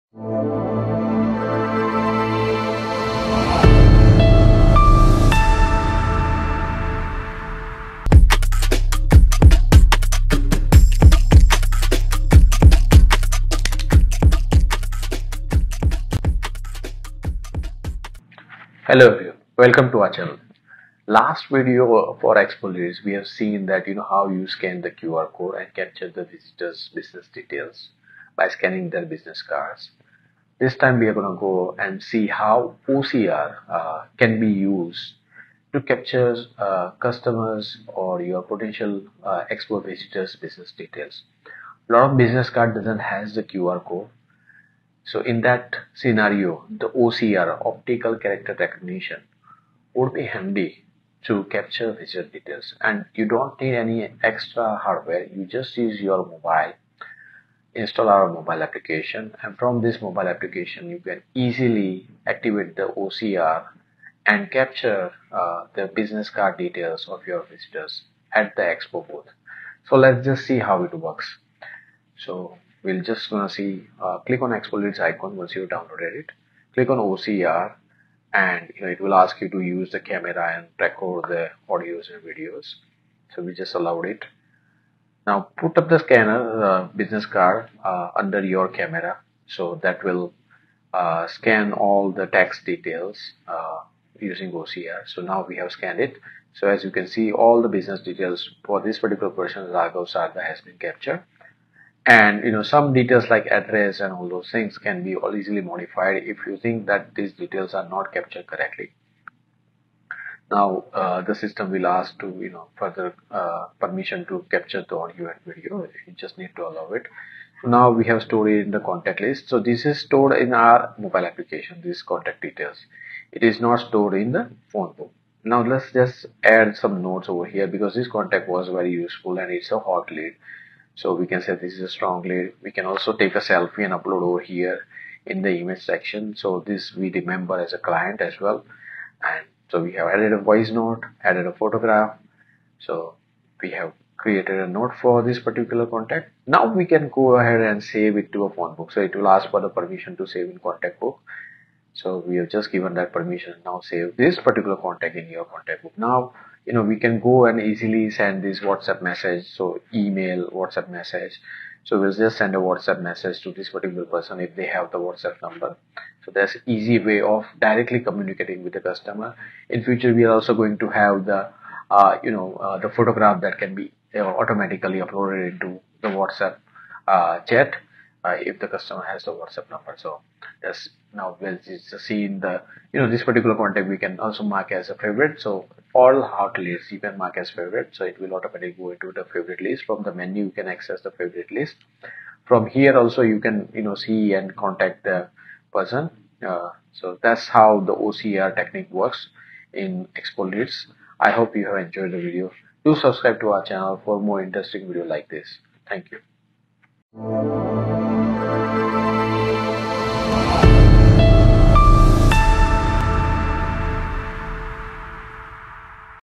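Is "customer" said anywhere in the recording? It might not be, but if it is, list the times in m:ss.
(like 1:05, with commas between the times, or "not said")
0:36, 2:48, 2:58.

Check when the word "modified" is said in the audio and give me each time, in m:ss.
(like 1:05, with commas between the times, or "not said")
1:45.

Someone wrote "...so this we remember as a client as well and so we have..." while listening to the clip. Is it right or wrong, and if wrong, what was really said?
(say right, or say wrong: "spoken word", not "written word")
right.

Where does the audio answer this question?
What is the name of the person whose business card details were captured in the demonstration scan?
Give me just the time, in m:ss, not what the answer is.
1:39.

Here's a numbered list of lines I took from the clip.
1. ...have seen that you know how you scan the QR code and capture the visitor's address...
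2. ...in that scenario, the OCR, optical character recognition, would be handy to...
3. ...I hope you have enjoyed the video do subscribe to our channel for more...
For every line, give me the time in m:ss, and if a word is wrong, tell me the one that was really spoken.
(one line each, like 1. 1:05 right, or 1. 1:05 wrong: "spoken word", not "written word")
1. 0:23 wrong: "business", not "address"
2. 0:45 right
3. 3:21 right.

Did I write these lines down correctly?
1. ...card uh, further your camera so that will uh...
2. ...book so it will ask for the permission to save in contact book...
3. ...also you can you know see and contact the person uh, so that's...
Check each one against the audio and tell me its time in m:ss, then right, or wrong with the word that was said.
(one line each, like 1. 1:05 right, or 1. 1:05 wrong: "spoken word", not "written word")
1. 1:27 wrong: "under", not "further"
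2. 2:28 right
3. 3:12 right.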